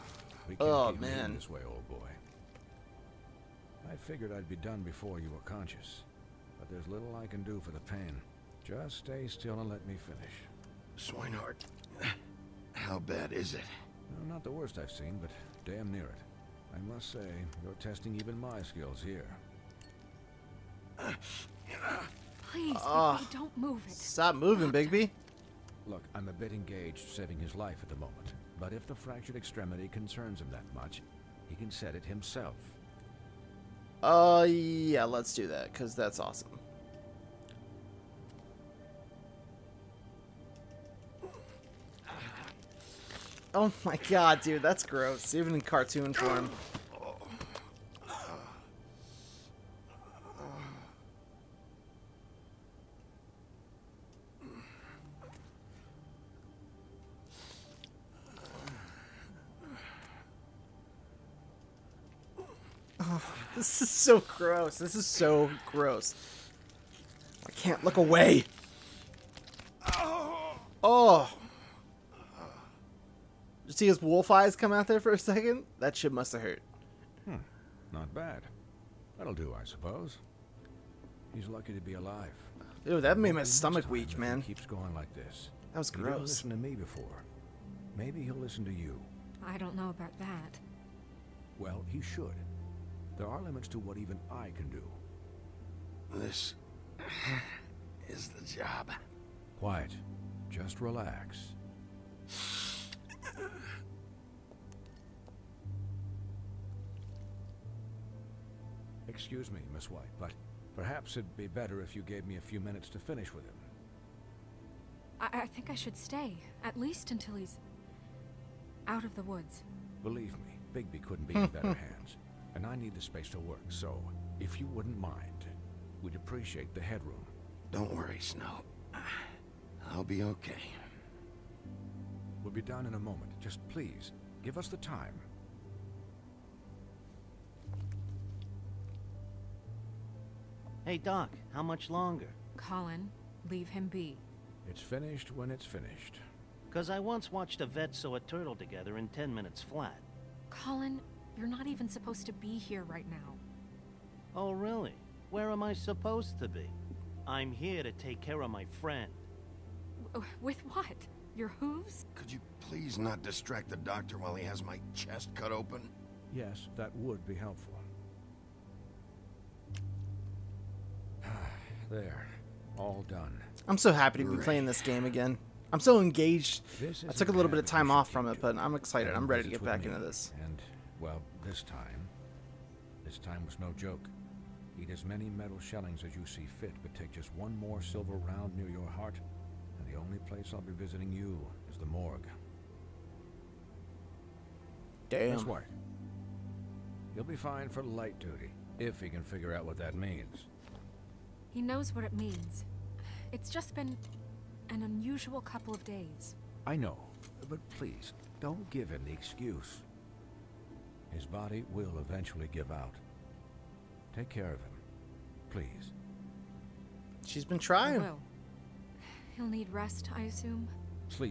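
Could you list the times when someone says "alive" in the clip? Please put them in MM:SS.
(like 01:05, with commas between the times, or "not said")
01:21.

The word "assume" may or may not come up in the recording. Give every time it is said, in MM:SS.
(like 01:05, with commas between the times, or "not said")
03:40.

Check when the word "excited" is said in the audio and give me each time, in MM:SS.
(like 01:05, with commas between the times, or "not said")
02:58.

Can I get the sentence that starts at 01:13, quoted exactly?
You see his wolf eyes come out there for a second?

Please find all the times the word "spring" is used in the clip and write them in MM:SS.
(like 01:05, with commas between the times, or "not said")
not said.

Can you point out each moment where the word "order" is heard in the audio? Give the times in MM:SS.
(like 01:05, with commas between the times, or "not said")
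not said.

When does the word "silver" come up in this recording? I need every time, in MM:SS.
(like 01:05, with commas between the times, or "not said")
03:07.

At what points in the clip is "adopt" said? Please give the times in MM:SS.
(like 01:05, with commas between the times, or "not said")
not said.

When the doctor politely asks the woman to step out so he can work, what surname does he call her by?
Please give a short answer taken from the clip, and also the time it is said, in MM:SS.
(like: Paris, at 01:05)
White, at 01:49.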